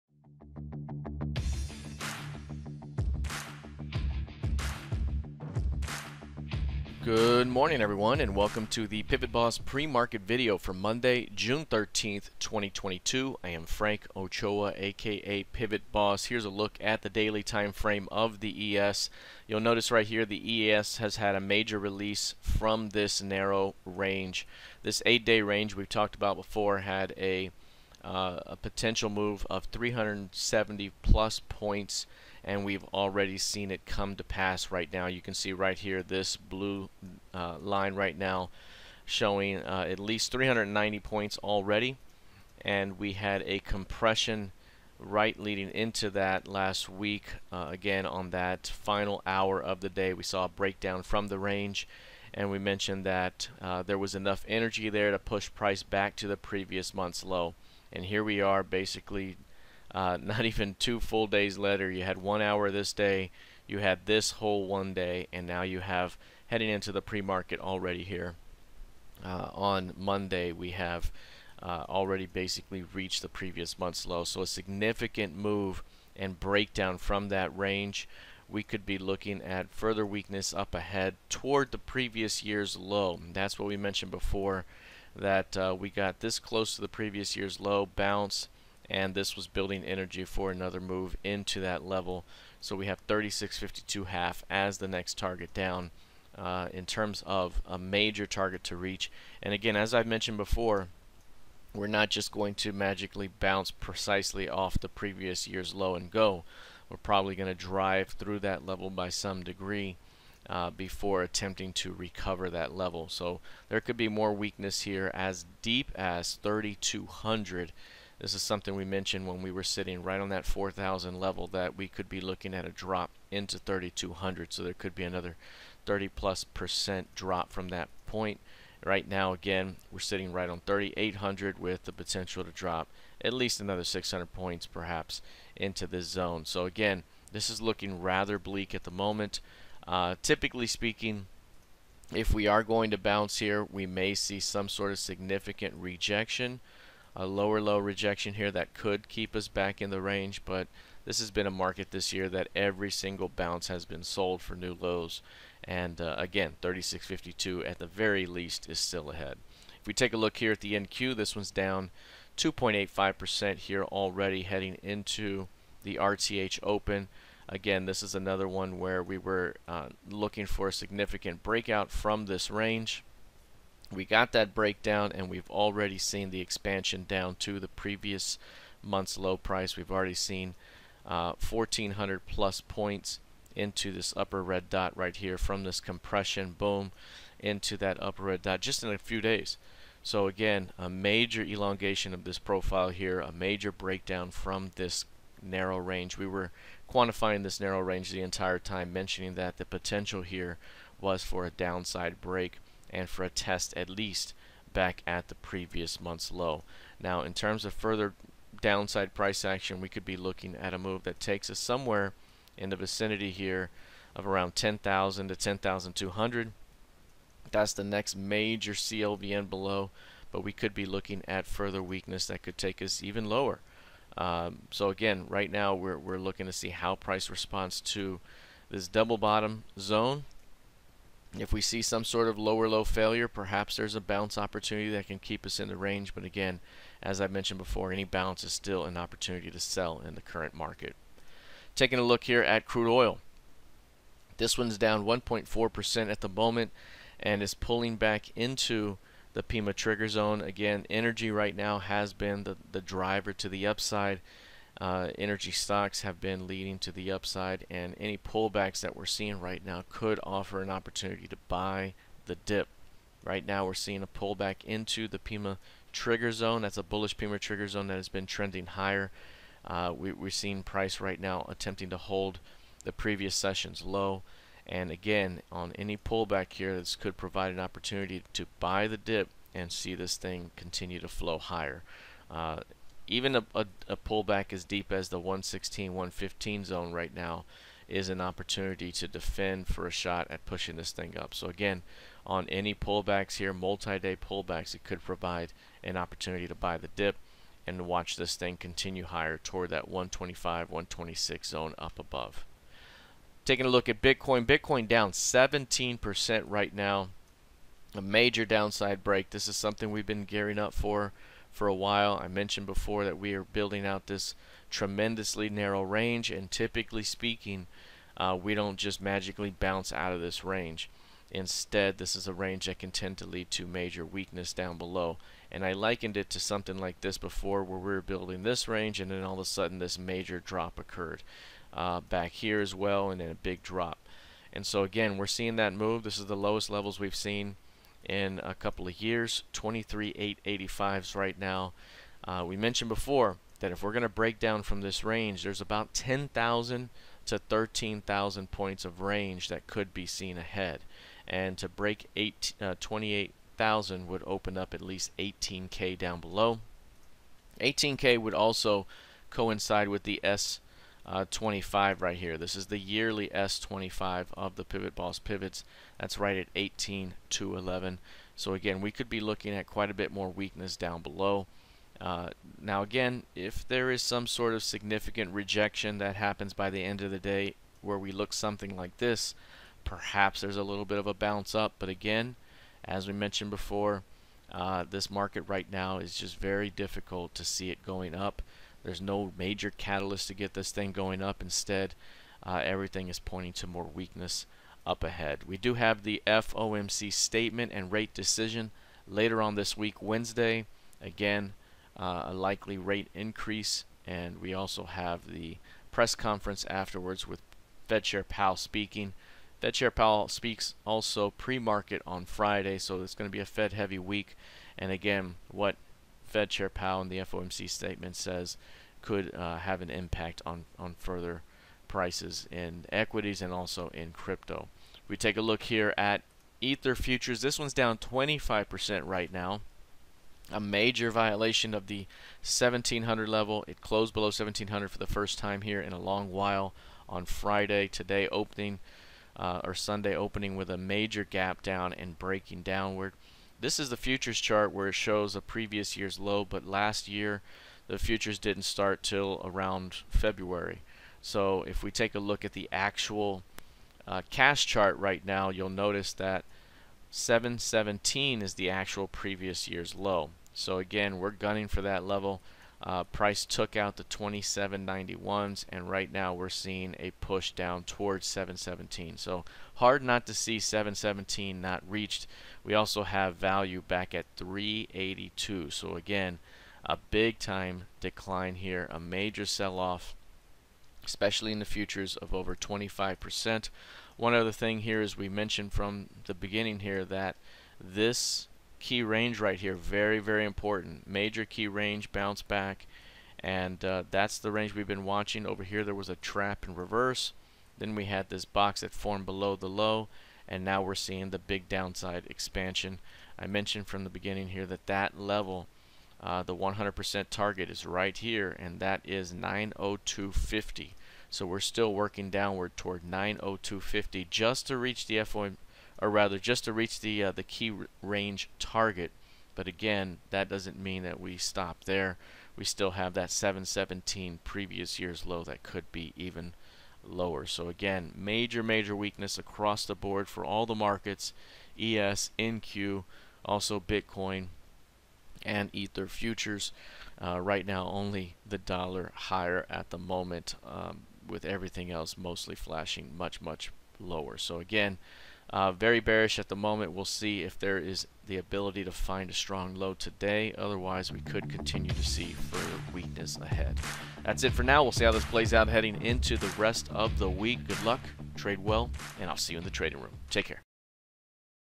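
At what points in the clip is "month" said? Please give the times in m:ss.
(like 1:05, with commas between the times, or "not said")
0:56, 1:13, 2:58, 3:25.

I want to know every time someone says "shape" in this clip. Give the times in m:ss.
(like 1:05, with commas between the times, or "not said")
not said.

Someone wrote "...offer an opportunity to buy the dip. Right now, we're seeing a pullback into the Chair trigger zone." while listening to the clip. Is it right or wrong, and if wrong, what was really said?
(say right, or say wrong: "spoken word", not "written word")
wrong: "PIMA", not "Chair".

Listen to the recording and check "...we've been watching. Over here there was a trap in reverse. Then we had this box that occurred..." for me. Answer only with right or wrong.
wrong.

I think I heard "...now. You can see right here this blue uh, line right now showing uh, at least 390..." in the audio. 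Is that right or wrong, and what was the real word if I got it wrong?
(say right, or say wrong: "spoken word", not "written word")
right.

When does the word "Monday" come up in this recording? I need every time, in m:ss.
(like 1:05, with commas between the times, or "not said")
0:10, 1:09.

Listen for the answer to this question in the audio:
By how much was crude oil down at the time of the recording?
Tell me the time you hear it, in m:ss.
4:05.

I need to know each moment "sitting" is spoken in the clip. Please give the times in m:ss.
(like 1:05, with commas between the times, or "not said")
1:59, 2:09.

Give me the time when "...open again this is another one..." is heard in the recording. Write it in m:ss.
2:46.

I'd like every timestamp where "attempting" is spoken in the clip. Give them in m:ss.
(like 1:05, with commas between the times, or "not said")
1:51, 4:31.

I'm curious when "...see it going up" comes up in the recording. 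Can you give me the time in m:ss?
6:27.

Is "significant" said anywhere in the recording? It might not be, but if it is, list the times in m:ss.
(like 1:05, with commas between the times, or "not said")
1:14, 2:24, 2:50, 6:14.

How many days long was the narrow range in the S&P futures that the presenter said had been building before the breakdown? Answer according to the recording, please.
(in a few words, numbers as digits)
8.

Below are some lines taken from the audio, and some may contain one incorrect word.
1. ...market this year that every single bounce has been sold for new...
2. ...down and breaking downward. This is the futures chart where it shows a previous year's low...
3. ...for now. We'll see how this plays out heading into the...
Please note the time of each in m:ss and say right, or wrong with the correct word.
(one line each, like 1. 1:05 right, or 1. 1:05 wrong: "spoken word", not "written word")
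1. 2:31 right
2. 7:21 right
3. 9:14 right.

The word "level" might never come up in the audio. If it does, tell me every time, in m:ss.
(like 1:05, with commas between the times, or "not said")
1:31, 1:48, 1:52, 2:01, 5:36, 7:13, 7:42, 8:25.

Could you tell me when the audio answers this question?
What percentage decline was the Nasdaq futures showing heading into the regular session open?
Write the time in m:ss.
2:42.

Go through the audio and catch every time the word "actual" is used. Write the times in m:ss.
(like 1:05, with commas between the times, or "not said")
7:32, 7:38.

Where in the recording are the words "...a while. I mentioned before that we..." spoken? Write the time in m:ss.
5:11.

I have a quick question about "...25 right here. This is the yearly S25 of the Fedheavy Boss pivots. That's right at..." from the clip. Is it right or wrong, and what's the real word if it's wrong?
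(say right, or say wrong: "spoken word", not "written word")
wrong: "Pivot", not "Fedheavy".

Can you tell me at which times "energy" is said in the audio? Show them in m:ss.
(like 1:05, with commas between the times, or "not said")
0:54, 1:29, 4:10, 4:15.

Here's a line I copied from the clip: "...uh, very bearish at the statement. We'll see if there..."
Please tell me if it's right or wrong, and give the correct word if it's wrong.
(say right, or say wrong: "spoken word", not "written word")
wrong: "moment", not "statement".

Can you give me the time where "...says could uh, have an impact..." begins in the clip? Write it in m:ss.
6:58.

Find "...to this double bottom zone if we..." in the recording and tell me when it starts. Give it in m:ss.
3:47.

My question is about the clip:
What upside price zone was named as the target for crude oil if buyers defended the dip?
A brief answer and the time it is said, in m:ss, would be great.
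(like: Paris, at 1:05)
125-126, at 4:59.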